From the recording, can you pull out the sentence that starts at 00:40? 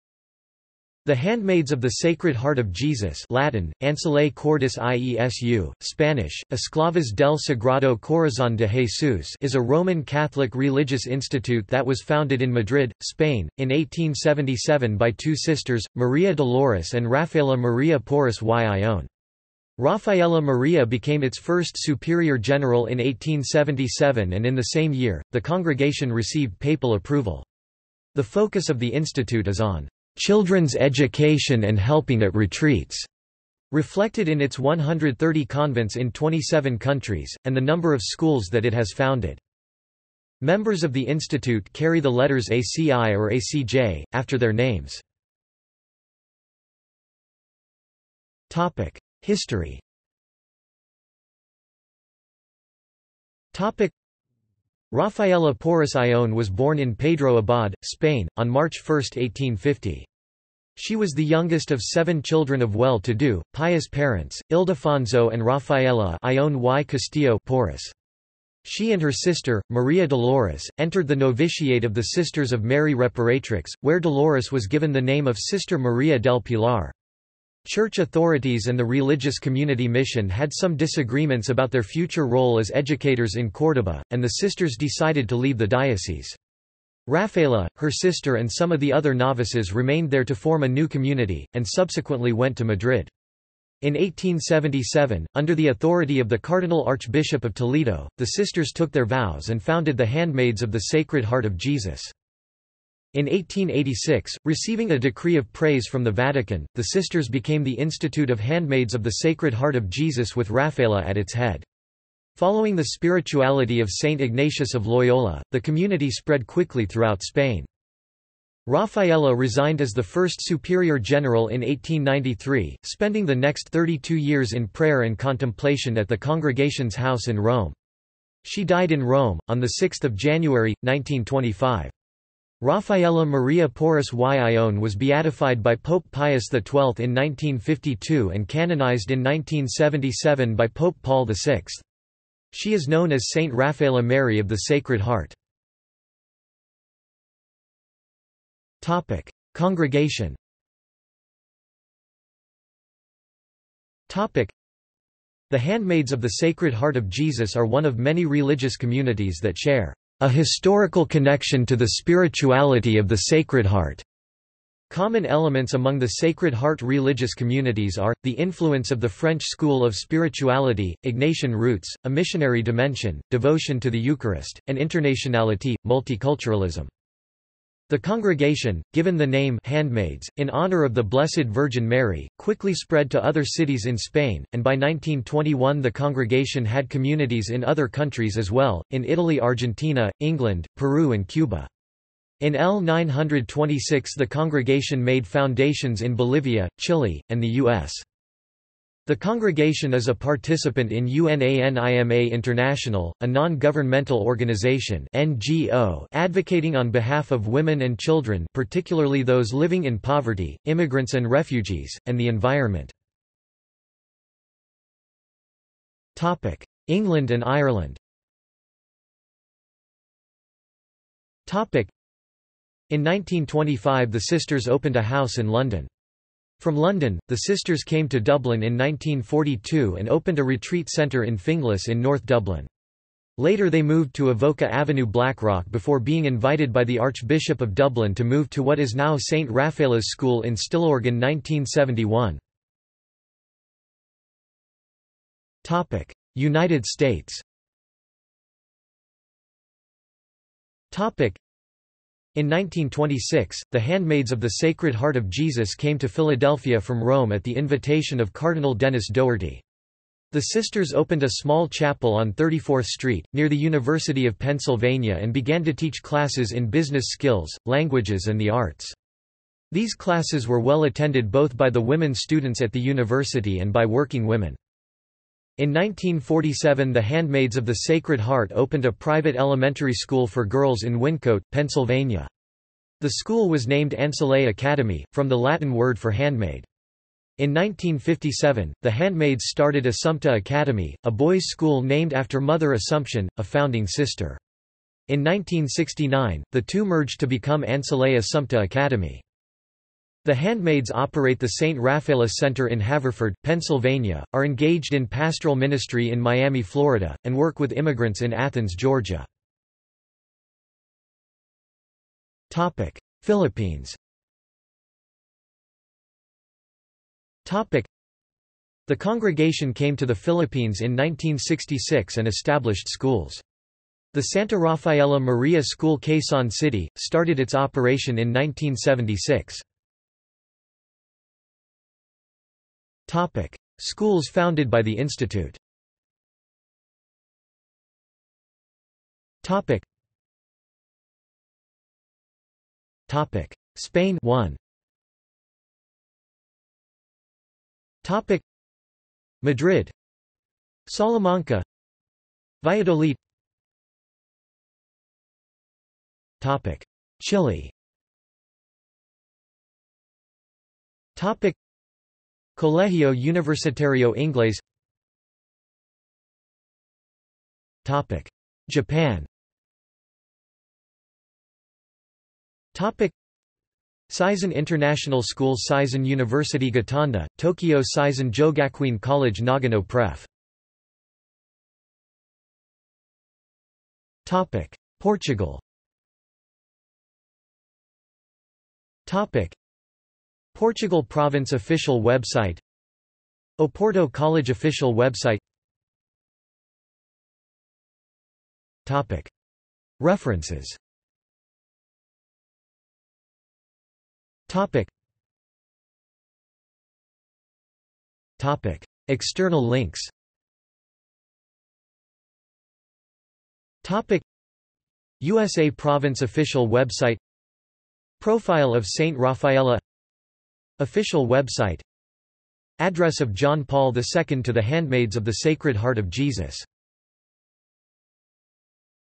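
Members of the institute carry the letters ACI or ACJ, after their names.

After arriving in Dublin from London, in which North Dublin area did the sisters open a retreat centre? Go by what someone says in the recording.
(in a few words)
Finglas.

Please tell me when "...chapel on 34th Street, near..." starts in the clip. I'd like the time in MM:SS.
04:21.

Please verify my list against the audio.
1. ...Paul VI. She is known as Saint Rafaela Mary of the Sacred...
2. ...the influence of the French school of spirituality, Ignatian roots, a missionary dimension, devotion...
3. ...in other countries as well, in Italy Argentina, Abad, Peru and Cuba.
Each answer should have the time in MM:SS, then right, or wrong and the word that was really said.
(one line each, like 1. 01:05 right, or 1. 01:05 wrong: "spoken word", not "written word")
1. 02:21 right
2. 02:48 right
3. 03:07 wrong: "England", not "Abad".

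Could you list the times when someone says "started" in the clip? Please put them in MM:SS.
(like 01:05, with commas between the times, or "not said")
04:49, 05:26.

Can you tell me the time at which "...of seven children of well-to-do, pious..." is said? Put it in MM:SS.
01:01.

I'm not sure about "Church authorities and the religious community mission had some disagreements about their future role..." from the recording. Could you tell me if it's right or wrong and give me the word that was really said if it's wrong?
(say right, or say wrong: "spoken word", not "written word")
right.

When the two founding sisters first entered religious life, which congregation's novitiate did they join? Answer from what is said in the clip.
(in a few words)
Sisters of Mary Reparatrix.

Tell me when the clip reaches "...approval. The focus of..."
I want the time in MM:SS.
00:26.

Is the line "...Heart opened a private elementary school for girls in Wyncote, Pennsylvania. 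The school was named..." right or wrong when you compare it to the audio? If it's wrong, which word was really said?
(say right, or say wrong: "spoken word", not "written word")
right.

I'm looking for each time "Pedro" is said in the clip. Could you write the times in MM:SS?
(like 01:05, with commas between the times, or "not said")
00:56.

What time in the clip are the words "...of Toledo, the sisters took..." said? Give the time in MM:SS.
01:37.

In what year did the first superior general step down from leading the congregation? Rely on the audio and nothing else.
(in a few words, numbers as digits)
1893.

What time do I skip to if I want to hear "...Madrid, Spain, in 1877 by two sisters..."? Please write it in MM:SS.
00:12.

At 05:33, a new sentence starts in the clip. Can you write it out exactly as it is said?
Topic: Schools founded by the institute.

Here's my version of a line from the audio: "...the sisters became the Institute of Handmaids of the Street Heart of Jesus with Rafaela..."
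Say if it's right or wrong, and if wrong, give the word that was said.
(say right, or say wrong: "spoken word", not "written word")
wrong: "Sacred", not "Street".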